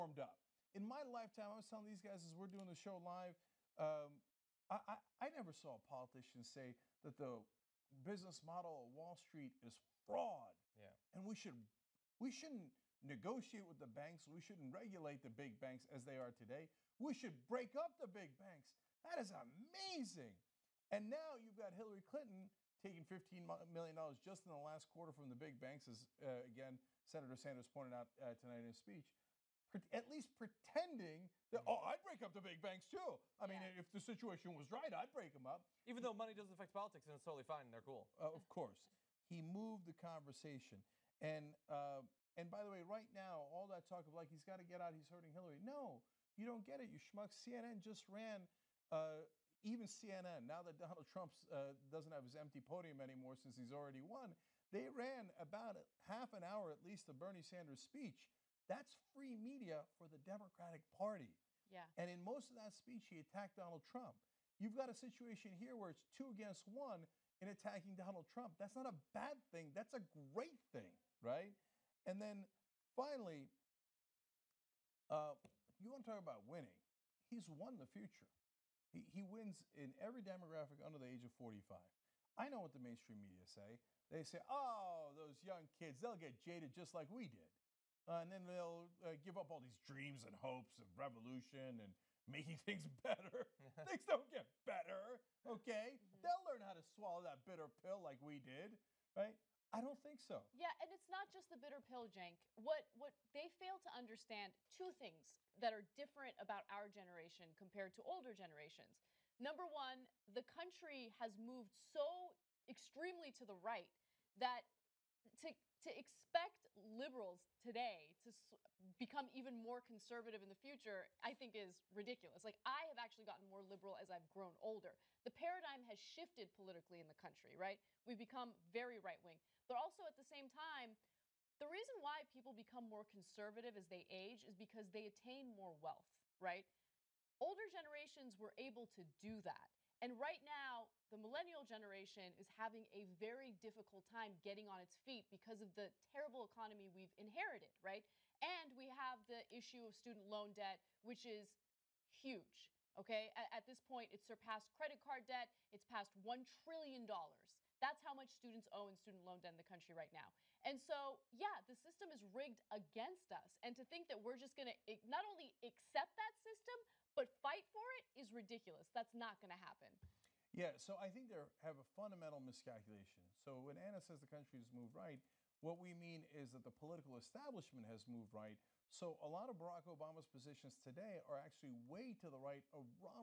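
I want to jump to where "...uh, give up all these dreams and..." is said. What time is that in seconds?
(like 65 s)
89 s.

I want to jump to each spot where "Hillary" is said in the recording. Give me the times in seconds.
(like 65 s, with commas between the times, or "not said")
21 s, 45 s.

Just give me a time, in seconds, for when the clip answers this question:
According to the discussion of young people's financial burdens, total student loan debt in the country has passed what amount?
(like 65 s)
156 s.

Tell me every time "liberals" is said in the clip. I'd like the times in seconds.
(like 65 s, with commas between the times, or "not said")
116 s, 123 s.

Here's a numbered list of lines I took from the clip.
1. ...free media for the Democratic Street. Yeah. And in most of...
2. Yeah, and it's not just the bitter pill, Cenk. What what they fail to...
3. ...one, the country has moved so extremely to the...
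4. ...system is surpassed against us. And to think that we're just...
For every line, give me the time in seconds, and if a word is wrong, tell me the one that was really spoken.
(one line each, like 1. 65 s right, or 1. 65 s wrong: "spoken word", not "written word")
1. 59 s wrong: "Party", not "Street"
2. 100 s right
3. 109 s right
4. 161 s wrong: "rigged", not "surpassed".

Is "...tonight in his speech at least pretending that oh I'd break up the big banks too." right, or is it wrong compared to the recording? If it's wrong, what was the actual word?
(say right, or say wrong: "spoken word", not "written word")
right.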